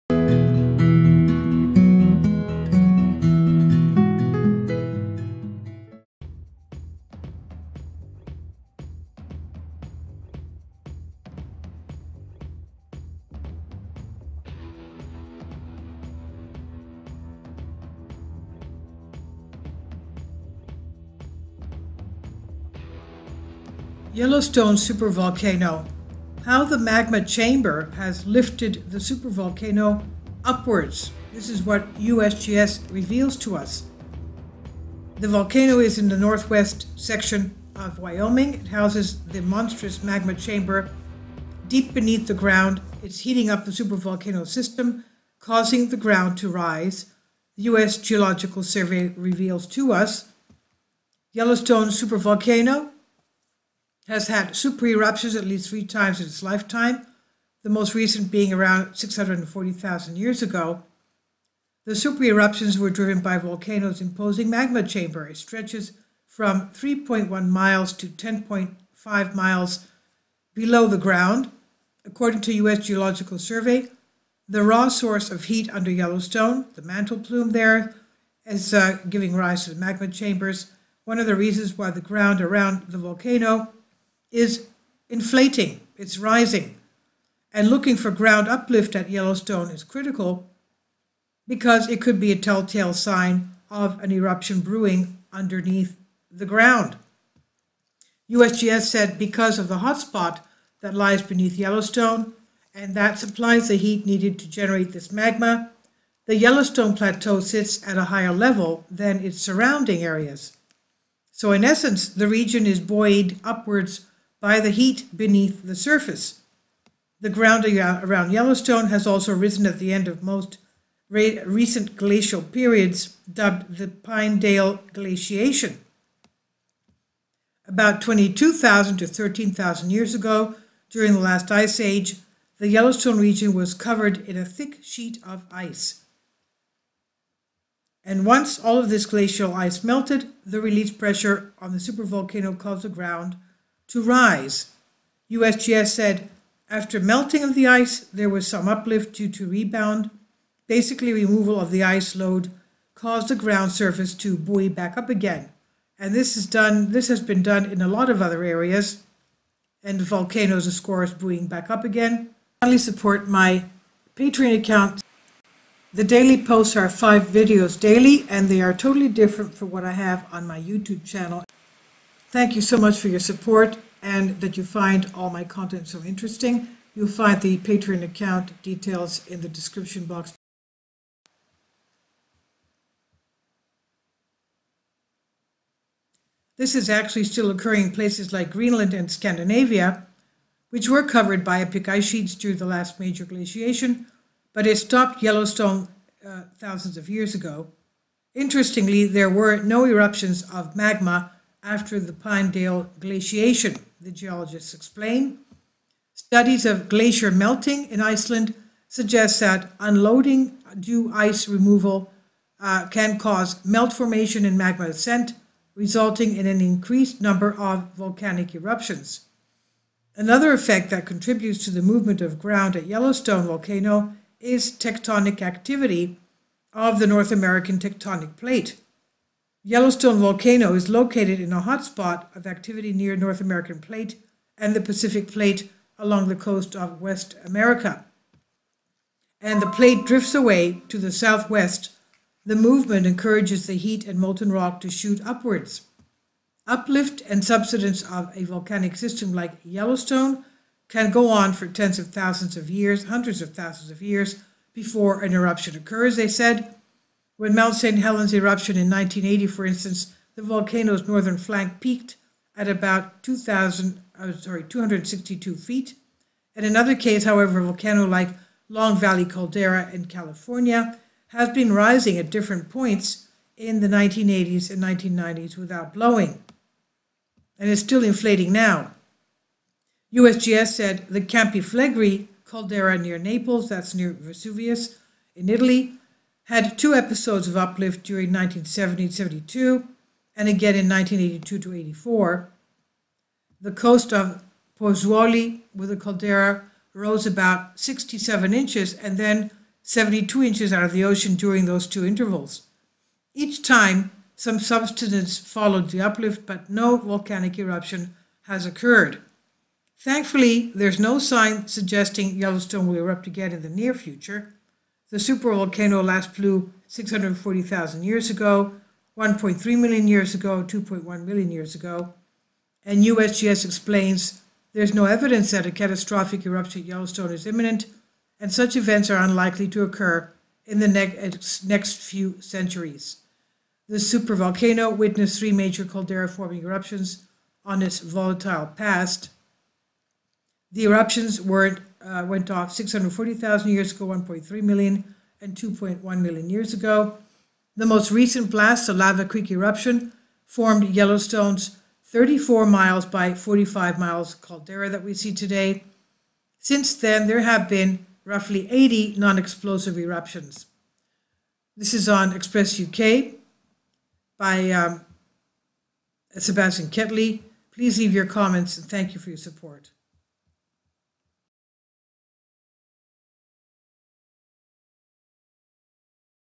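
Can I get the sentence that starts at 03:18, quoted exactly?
Interestingly, there were no eruptions of magma after the Pinedale glaciation, the geologists explain.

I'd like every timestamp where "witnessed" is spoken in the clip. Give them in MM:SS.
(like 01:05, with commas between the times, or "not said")
05:34.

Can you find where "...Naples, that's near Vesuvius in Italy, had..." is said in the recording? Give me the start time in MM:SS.
04:43.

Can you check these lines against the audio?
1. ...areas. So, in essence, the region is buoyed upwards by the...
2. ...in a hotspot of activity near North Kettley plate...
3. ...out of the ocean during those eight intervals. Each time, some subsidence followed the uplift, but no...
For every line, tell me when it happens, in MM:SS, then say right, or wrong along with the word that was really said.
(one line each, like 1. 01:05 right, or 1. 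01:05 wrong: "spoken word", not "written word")
1. 01:50 right
2. 03:51 wrong: "American", not "Kettley"
3. 05:00 wrong: "two", not "eight".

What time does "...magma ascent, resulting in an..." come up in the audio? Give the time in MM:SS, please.
03:34.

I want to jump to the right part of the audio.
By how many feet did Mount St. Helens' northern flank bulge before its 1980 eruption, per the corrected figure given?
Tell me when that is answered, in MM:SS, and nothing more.
04:24.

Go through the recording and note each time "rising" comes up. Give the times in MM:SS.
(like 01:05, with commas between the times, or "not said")
01:26, 04:31.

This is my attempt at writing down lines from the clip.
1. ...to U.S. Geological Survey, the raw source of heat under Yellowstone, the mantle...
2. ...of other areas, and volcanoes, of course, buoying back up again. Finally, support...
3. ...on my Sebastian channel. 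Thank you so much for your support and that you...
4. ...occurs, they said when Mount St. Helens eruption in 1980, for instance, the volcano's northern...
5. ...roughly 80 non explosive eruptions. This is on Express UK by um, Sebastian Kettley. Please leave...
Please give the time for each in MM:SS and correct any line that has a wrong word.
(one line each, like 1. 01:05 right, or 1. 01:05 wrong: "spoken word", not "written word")
1. 01:12 right
2. 02:38 right
3. 02:50 wrong: "YouTube", not "Sebastian"
4. 04:15 right
5. 05:58 right.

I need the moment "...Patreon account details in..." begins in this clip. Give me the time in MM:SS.
02:57.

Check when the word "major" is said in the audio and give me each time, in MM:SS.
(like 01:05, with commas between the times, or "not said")
03:12, 05:35.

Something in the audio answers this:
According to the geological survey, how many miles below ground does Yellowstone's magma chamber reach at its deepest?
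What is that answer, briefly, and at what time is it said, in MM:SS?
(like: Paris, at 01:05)
10.5 miles, at 01:08.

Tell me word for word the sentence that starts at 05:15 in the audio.
The supervolcano last flew 640,000 years ago, 1.3 million years ago, 2.1 million years ago.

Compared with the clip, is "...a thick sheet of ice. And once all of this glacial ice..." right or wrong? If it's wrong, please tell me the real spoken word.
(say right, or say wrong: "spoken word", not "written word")
right.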